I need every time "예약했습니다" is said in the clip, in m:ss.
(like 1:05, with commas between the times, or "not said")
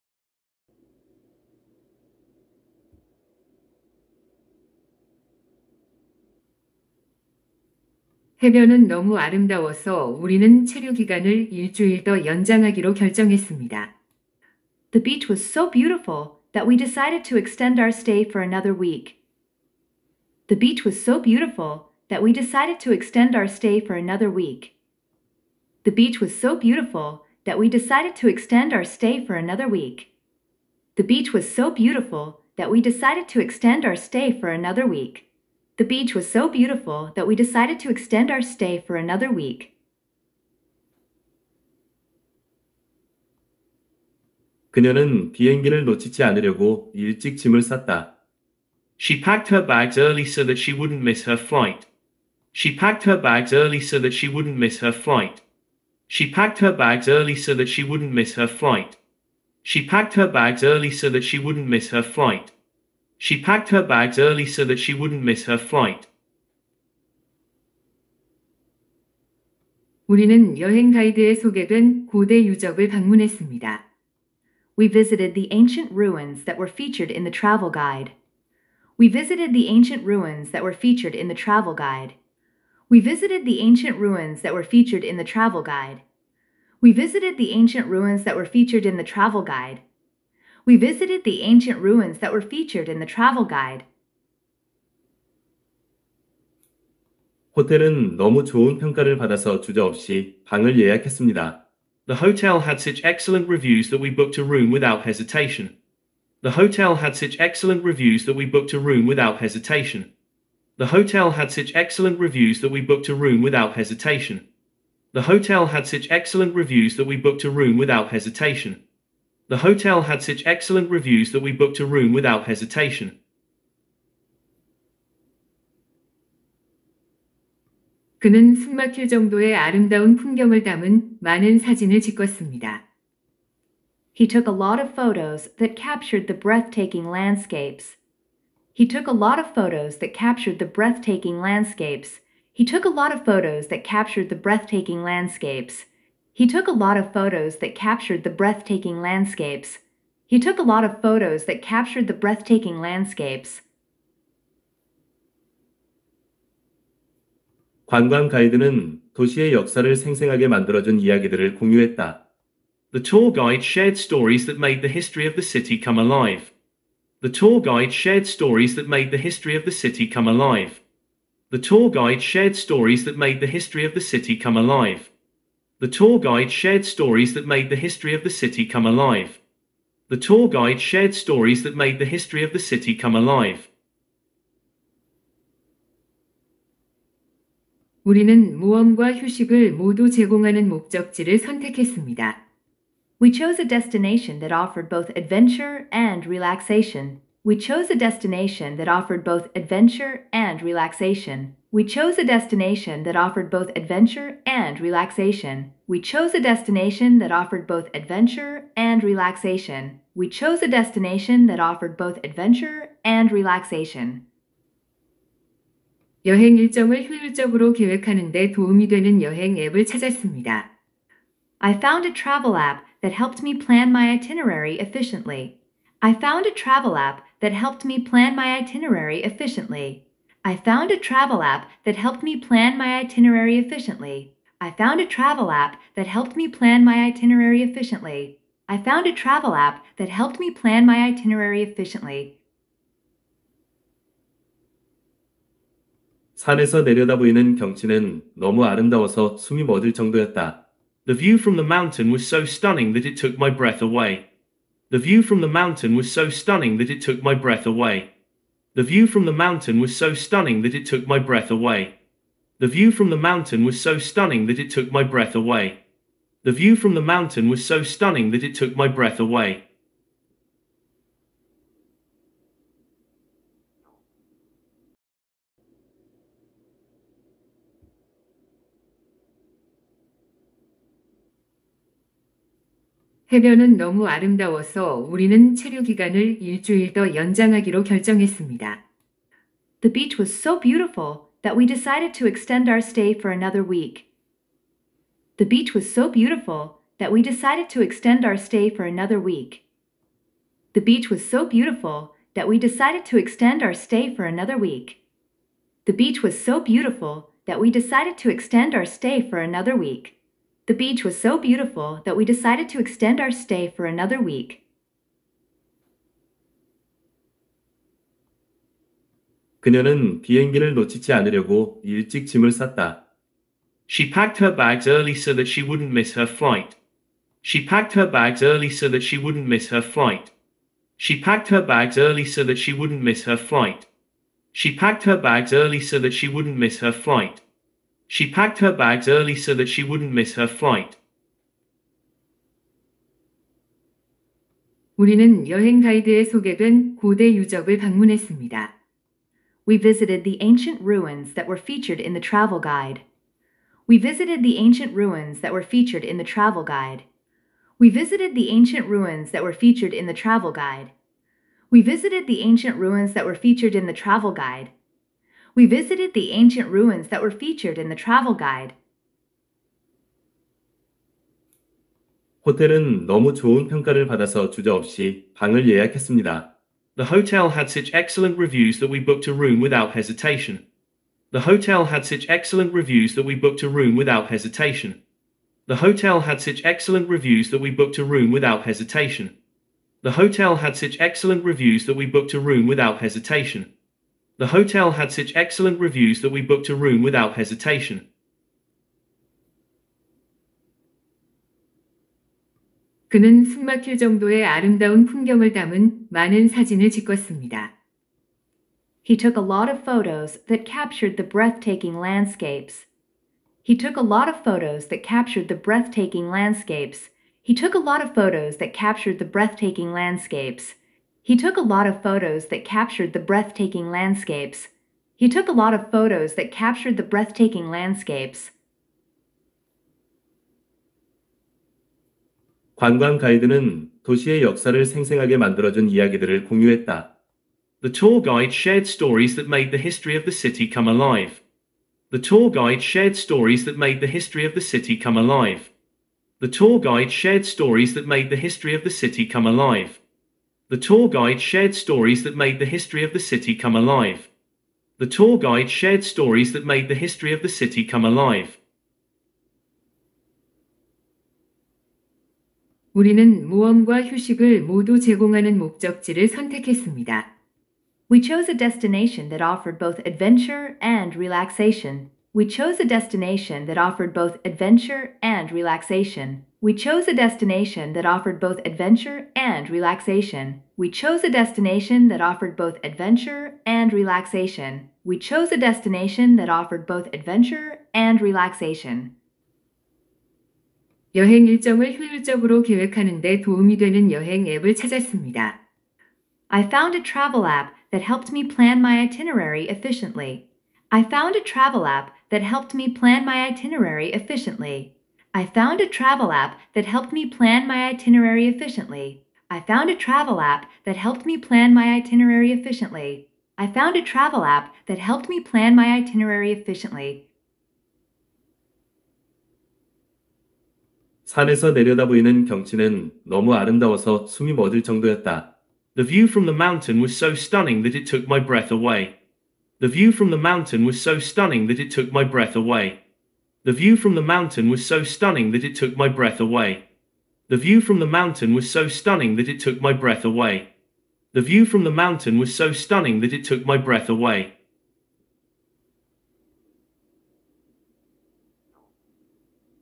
1:40, 6:15.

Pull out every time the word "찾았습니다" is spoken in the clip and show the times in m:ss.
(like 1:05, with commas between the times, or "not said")
3:39, 8:14.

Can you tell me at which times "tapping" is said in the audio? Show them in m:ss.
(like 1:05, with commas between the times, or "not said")
not said.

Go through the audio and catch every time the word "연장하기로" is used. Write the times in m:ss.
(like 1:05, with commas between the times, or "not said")
0:12, 4:47.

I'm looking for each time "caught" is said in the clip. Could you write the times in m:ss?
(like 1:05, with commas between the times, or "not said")
not said.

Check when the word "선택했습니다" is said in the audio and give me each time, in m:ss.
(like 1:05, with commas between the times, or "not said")
3:11, 7:46.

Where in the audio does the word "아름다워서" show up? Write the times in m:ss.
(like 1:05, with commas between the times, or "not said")
0:09, 4:08, 4:44, 8:43.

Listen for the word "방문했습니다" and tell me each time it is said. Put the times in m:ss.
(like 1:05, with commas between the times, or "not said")
1:12, 5:47.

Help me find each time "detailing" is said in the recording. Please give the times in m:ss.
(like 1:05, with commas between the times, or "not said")
not said.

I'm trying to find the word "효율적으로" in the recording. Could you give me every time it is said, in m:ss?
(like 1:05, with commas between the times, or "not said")
3:37, 8:11.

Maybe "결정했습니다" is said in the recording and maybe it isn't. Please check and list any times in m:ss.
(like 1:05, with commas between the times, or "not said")
0:12, 4:47.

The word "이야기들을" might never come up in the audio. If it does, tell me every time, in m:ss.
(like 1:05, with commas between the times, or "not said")
2:41, 7:15.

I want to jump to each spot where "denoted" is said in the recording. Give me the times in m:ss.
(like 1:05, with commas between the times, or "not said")
not said.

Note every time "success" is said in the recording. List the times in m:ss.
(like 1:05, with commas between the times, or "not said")
not said.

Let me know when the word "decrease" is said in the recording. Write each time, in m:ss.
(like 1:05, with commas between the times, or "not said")
not said.